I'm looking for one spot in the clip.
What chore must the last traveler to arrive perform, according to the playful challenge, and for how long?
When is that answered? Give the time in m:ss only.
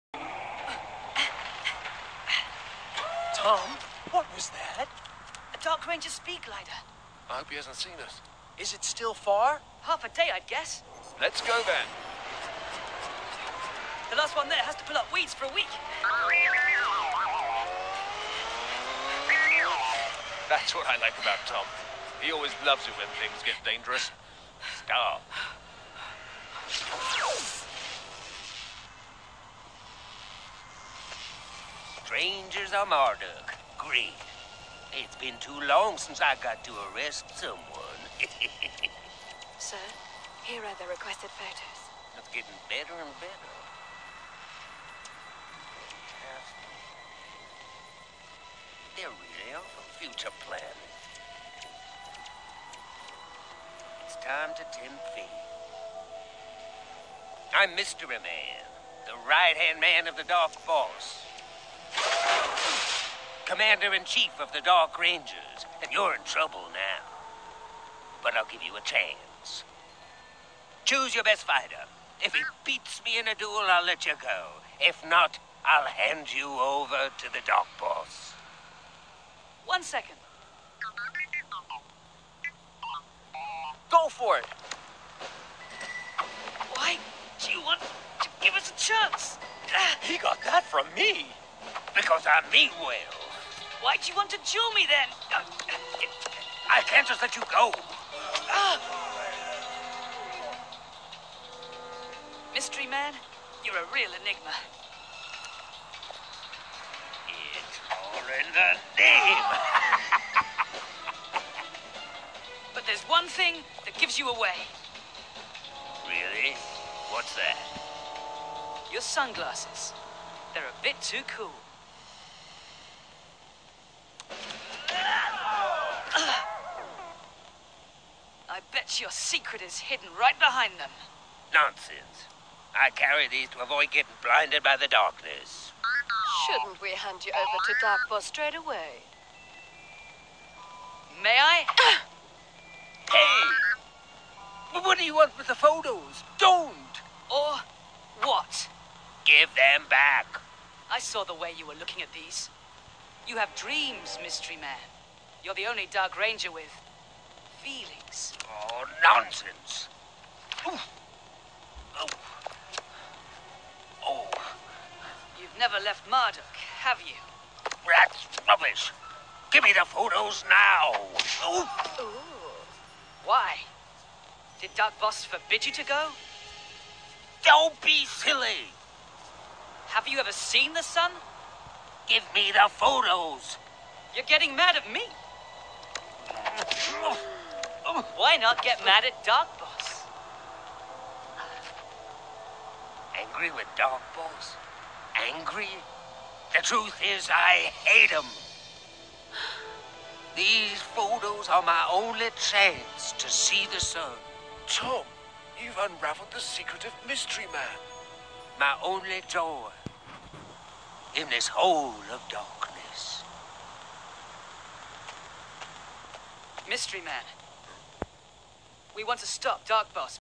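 0:14.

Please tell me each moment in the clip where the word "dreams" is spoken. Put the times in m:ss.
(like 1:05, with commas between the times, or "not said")
2:33.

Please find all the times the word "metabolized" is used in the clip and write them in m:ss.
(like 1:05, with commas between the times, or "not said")
not said.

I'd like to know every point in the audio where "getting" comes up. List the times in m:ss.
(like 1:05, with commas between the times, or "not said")
0:42, 2:13, 3:04.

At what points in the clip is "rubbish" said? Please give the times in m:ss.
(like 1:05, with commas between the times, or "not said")
2:48.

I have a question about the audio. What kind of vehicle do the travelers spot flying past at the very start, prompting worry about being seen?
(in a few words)
Dark Ranger speed glider.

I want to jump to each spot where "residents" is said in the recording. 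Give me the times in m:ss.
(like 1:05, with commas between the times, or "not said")
not said.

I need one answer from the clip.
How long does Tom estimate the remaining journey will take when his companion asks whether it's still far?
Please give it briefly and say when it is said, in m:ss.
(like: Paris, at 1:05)
Half a day, at 0:09.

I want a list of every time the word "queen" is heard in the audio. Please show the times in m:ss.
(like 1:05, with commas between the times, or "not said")
not said.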